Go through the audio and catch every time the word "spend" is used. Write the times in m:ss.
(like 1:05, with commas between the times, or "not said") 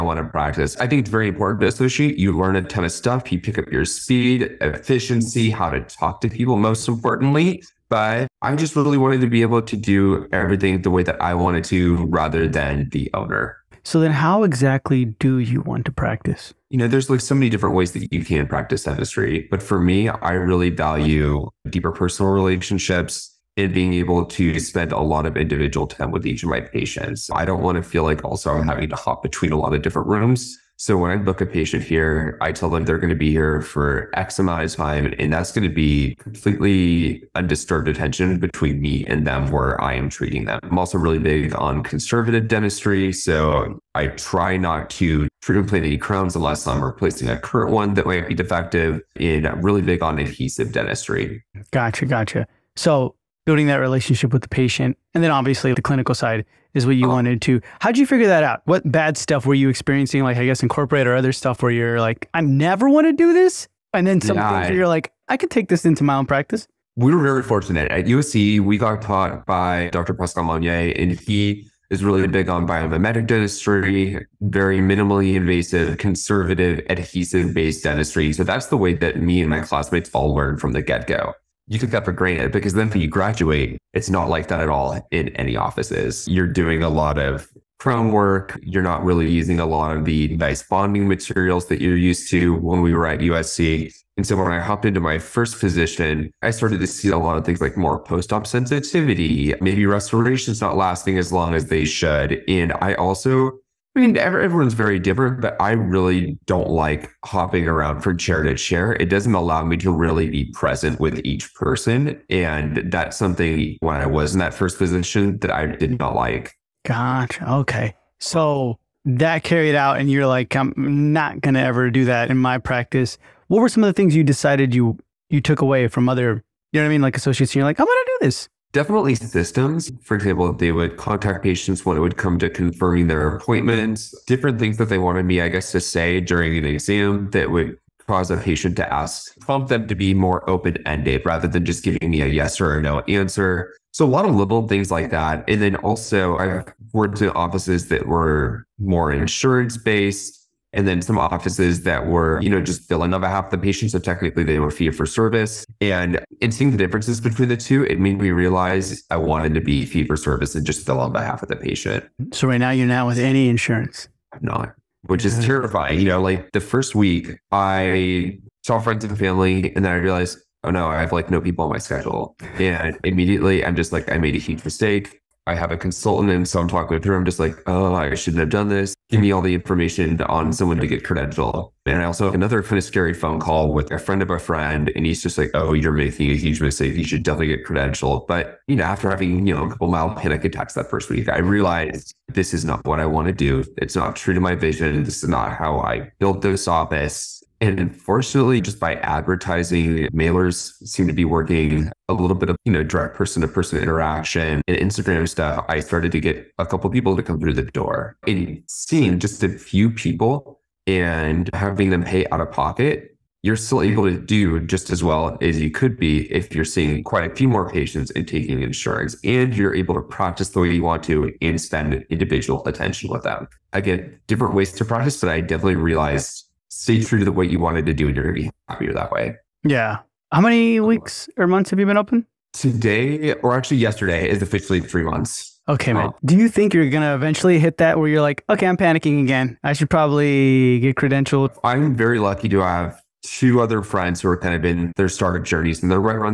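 0:24, 3:41.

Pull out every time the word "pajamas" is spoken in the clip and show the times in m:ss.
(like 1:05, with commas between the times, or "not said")
not said.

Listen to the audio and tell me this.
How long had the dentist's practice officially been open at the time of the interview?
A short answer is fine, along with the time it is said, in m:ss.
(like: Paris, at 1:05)
3 months, at 3:54.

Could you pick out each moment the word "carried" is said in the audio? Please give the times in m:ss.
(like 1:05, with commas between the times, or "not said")
1:59.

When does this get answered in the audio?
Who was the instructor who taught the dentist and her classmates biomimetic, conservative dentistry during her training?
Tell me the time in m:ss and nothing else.
1:09.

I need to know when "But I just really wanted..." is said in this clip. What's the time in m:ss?
0:07.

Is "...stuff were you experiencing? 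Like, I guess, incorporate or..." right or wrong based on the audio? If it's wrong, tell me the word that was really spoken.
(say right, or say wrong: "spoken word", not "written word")
right.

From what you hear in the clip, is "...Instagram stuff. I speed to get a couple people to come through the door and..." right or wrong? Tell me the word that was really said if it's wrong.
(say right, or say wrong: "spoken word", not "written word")
wrong: "started", not "speed".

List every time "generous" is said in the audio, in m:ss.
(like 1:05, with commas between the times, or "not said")
not said.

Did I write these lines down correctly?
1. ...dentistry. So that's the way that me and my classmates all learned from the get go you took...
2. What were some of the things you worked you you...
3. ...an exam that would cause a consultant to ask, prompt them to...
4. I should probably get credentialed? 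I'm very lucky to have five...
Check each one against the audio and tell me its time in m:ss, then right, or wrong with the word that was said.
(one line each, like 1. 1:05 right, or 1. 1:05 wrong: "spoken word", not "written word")
1. 1:17 right
2. 2:03 wrong: "decided", not "worked"
3. 2:16 wrong: "patient", not "consultant"
4. 3:59 wrong: "two", not "five".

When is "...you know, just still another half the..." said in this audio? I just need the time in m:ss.
2:32.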